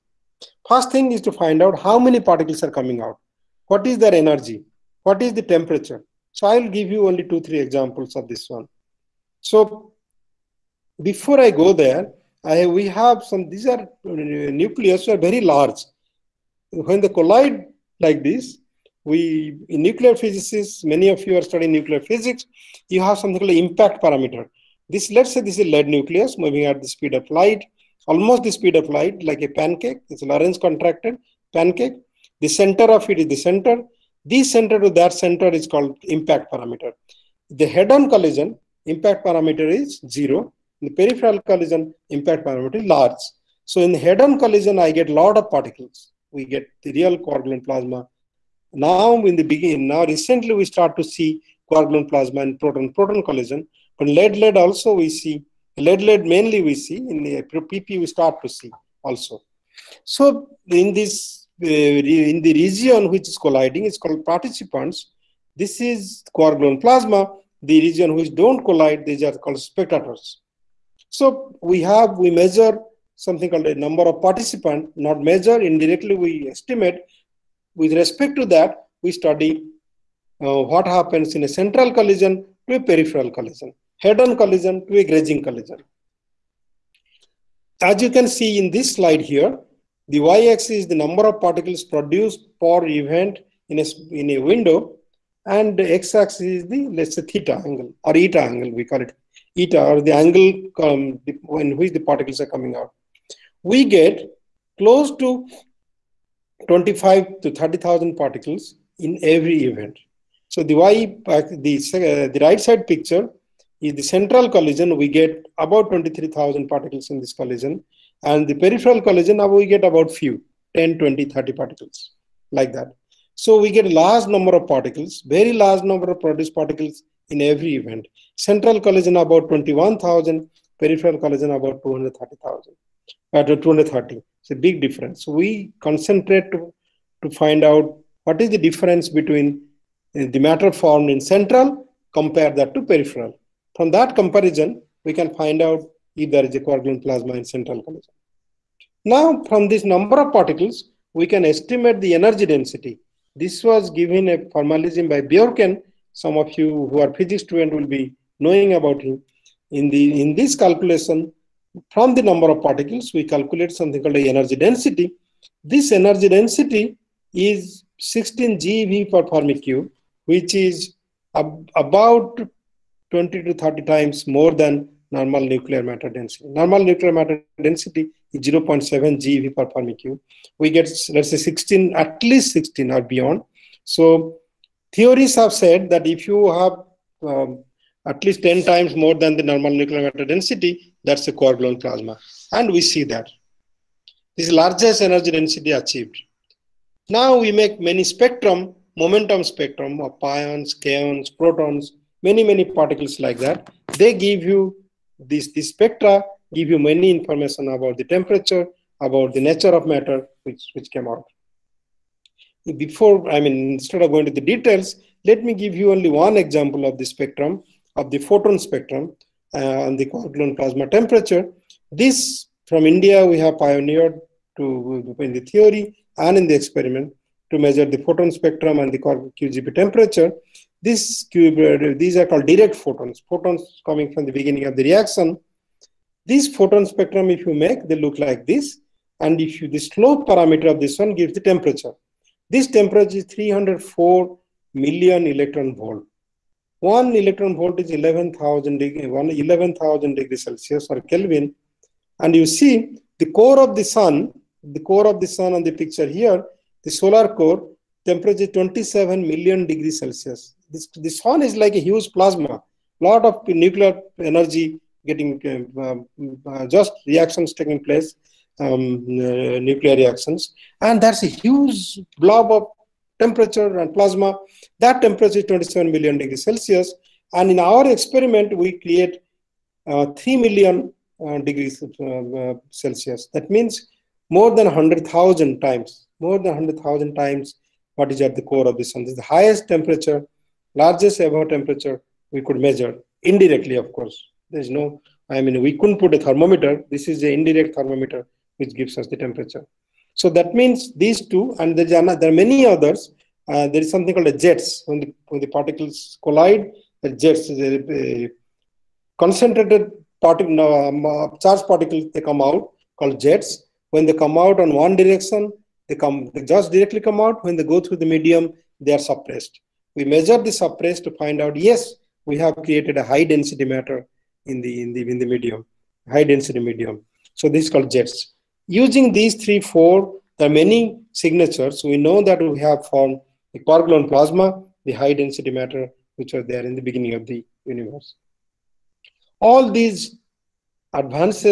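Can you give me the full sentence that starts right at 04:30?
And that's a huge blob of temperature and plasma.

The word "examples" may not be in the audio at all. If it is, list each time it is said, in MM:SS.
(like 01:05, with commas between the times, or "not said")
00:07, 03:36.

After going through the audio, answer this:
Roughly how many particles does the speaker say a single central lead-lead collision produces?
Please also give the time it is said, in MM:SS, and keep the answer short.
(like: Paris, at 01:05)
23,000, at 01:55.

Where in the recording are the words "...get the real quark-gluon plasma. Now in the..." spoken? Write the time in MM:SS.
00:46.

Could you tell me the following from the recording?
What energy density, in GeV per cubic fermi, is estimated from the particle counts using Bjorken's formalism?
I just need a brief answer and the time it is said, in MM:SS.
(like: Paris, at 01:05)
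16 GeV per Fermi cube, at 02:47.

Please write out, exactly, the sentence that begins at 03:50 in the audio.
This cube, uh, these are called direct photons, photons coming from the beginning of the reaction.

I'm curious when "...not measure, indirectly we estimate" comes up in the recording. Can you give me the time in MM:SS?
01:15.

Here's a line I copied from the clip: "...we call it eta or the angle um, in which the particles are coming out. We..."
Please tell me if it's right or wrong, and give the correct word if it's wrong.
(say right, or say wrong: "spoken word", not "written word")
right.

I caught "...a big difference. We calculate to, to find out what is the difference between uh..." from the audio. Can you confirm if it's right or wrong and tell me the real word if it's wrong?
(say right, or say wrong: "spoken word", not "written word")
wrong: "concentrate", not "calculate".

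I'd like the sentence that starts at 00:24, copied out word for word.
This, let's say this is lead nucleus moving at the speed of light, almost the speed of light, like a pancake.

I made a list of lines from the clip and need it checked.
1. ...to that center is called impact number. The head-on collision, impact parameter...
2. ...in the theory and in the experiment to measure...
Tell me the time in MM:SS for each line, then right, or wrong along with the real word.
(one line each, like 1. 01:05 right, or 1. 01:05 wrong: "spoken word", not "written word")
1. 00:34 wrong: "parameter", not "number"
2. 03:45 right.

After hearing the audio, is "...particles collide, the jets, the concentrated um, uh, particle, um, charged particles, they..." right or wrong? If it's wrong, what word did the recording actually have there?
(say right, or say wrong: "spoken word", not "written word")
right.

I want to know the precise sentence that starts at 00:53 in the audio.
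But lead-lead also we see, lead-lead mainly we see, in the PP we start to see also.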